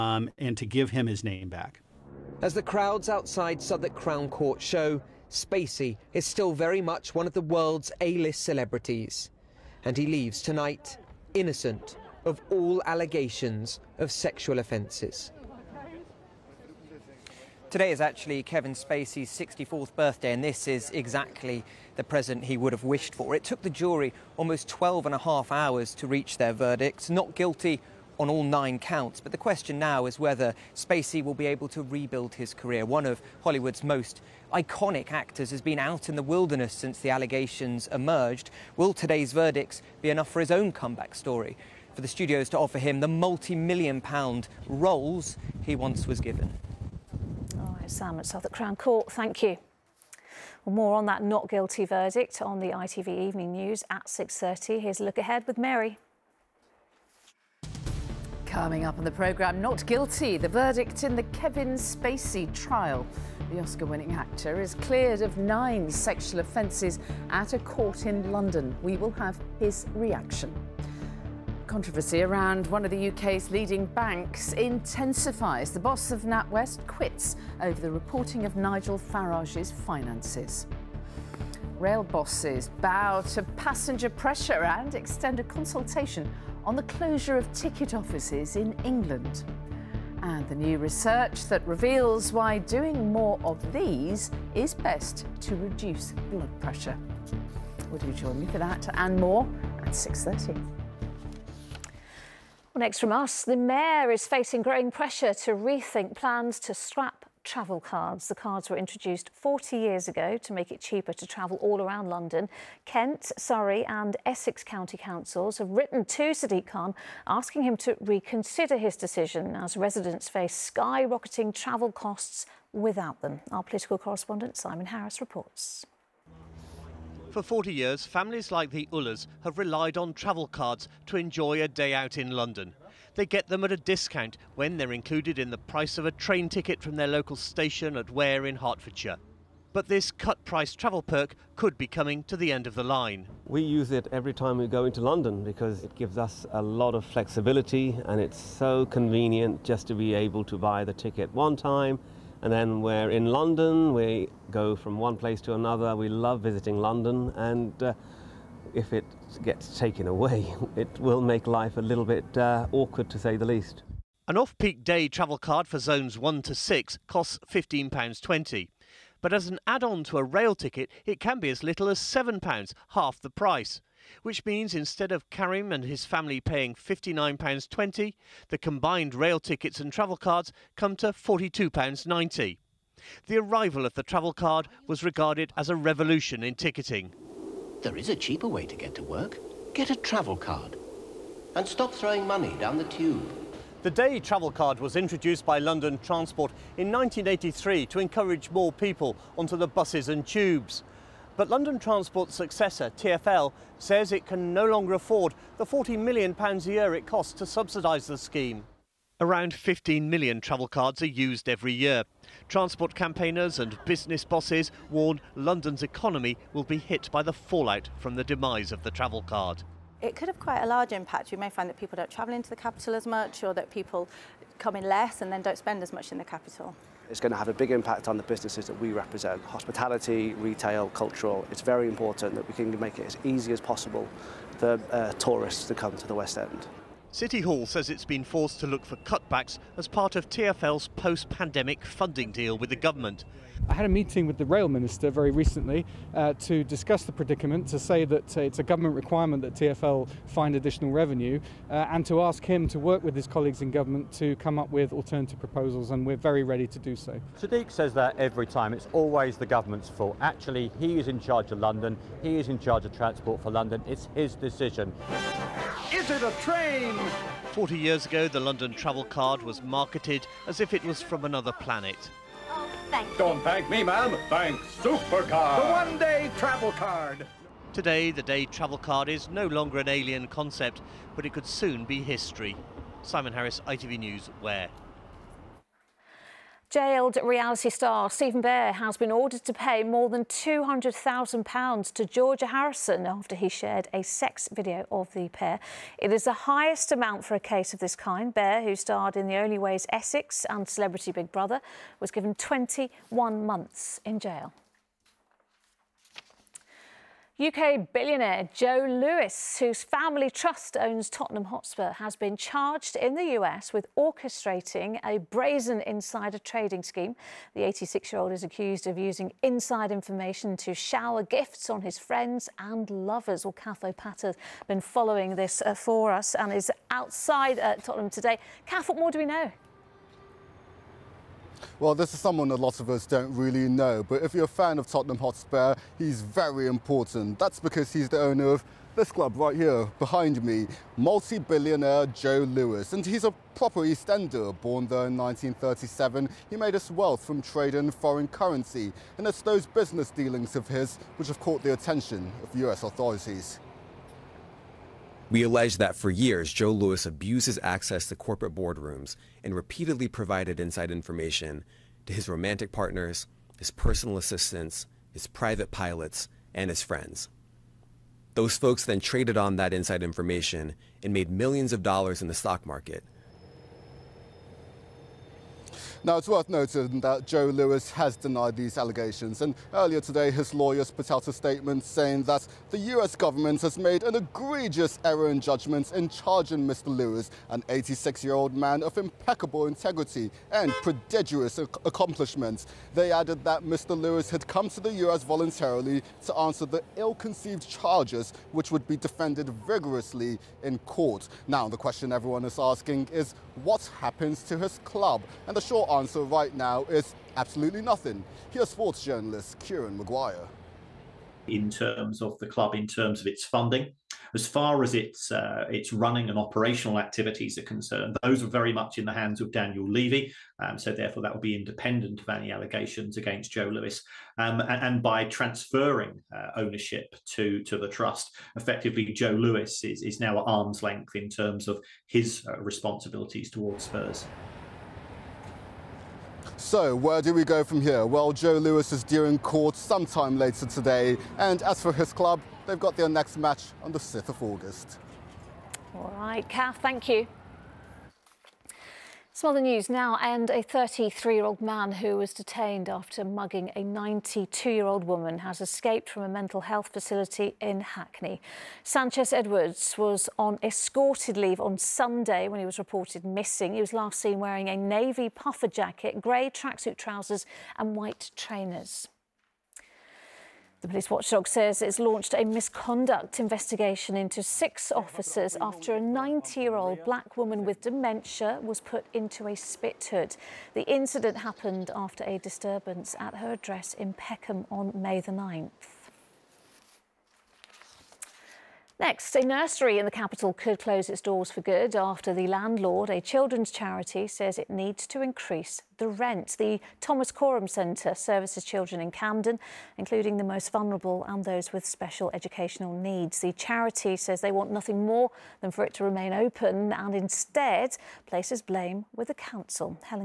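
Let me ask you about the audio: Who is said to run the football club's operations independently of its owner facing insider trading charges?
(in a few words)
Daniel Levy.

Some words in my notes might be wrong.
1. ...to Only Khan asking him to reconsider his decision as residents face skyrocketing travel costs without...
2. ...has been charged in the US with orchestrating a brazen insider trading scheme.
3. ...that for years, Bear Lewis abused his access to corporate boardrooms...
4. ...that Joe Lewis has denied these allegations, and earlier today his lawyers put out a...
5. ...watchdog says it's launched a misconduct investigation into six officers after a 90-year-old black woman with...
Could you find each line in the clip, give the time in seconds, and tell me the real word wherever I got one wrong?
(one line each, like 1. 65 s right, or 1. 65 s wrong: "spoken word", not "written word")
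1. 116 s wrong: "Sadiq", not "Only"
2. 311 s right
3. 355 s wrong: "Joe", not "Bear"
4. 376 s right
5. 471 s right.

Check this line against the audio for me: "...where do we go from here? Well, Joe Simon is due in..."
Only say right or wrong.
wrong.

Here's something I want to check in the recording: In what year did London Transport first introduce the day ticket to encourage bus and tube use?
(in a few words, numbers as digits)
1983.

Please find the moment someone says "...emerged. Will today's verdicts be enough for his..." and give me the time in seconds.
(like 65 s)
37 s.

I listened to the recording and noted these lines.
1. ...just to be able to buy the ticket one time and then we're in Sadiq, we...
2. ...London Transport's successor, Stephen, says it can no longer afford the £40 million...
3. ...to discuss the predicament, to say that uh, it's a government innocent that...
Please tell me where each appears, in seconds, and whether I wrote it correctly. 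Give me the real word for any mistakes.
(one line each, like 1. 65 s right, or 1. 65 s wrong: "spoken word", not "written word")
1. 149 s wrong: "London", not "Sadiq"
2. 201 s wrong: "TfL", not "Stephen"
3. 246 s wrong: "requirement", not "innocent".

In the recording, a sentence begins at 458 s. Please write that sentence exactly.
Sanchez Edwards was on escorted leave on Sunday when he was reported missing.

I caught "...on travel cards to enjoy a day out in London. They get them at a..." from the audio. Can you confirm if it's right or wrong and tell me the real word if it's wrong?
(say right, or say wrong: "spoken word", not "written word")
right.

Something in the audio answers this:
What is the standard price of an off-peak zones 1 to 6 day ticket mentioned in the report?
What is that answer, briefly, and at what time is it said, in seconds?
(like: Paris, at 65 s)
£15.20, at 167 s.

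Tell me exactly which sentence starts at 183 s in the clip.
The arrival of the travel card was regarded as a revolution in ticketing.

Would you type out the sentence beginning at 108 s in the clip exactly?
The cards were introduced 40 years ago to make it cheaper to travel all around London.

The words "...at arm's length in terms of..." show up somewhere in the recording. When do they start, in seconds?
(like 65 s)
430 s.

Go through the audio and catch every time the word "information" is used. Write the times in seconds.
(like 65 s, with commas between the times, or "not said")
319 s, 360 s, 370 s.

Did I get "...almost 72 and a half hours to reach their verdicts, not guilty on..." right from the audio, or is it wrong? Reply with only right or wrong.
wrong.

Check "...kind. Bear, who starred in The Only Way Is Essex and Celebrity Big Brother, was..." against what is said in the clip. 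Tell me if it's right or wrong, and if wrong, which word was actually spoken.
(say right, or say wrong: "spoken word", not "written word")
right.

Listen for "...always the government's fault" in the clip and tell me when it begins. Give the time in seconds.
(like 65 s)
258 s.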